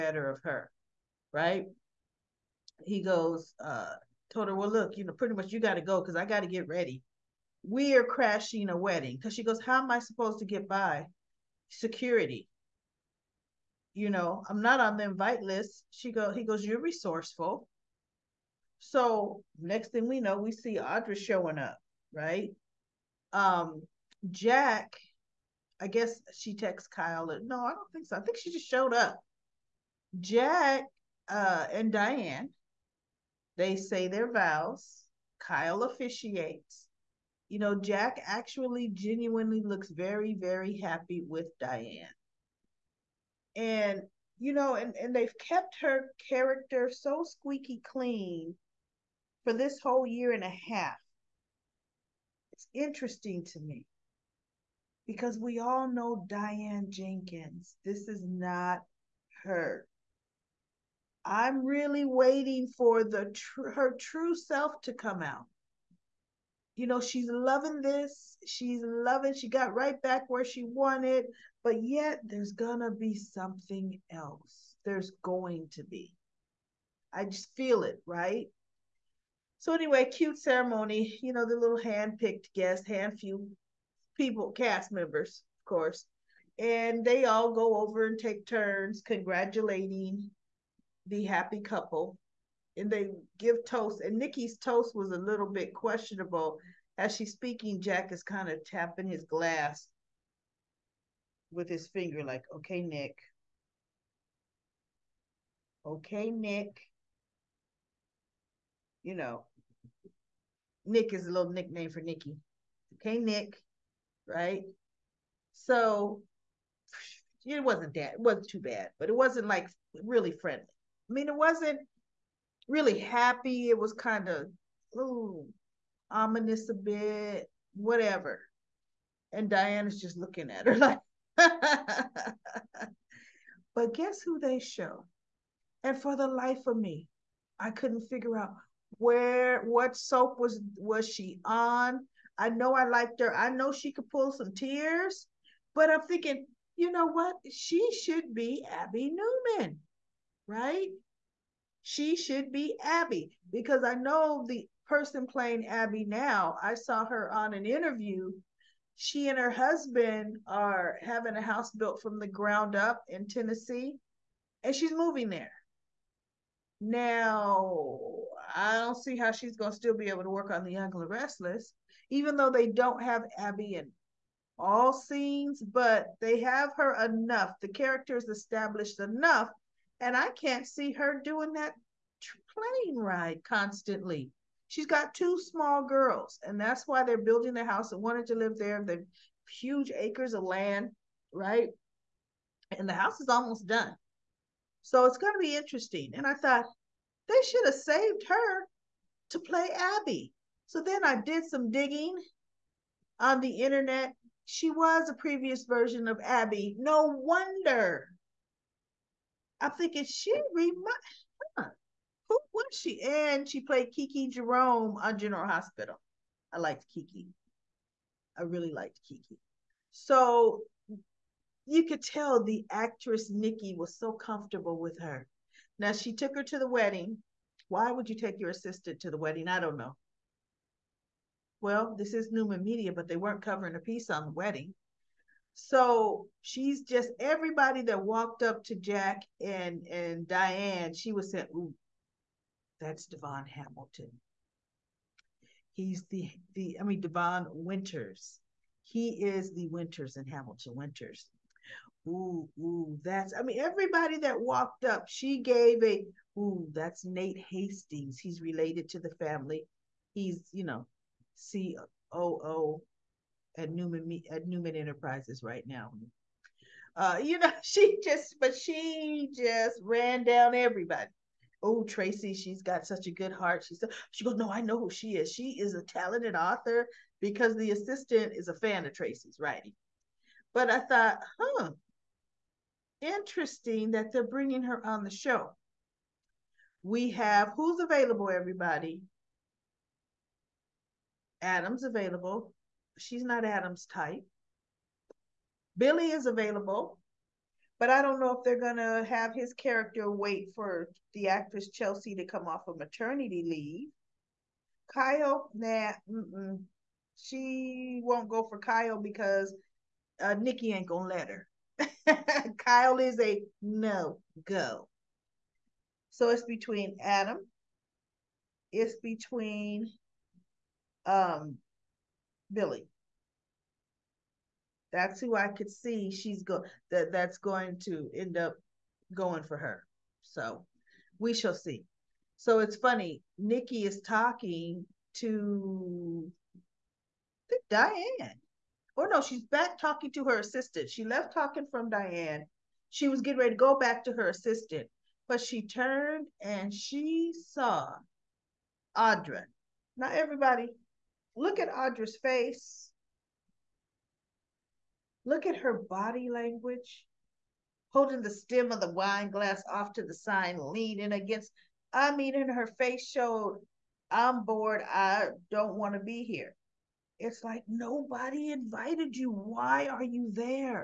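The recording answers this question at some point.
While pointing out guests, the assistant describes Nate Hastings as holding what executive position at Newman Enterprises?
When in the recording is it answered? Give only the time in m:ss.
4:21.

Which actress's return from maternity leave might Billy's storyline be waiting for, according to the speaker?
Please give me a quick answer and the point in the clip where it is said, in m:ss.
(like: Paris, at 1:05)
Chelsea, at 5:01.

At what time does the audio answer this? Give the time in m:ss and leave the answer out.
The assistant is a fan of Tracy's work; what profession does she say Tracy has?
4:36.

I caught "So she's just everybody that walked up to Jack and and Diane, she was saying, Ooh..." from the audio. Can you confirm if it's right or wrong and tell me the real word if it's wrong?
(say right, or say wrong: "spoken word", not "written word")
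right.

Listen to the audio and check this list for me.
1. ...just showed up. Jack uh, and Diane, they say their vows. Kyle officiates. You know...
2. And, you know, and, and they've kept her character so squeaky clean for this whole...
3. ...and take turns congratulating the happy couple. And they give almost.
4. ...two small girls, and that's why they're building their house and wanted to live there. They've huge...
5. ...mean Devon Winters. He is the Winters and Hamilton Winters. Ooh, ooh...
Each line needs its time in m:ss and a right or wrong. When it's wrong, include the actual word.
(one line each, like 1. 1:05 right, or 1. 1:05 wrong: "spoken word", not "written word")
1. 0:28 right
2. 0:43 right
3. 1:28 wrong: "toast", not "almost"
4. 3:05 right
5. 4:06 right.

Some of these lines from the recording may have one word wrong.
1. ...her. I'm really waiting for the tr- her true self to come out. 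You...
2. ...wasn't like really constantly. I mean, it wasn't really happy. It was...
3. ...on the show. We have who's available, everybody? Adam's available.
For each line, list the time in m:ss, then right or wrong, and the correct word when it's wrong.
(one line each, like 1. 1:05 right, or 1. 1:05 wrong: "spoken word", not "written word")
1. 0:59 right
2. 1:59 wrong: "friendly", not "constantly"
3. 4:44 right.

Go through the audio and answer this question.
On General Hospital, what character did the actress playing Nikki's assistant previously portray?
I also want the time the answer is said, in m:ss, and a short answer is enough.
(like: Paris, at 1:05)
Kiki Jerome, at 3:33.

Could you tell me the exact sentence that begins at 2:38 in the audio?
She and her husband are having a house built from the ground up in Tennessee, and she's moving there.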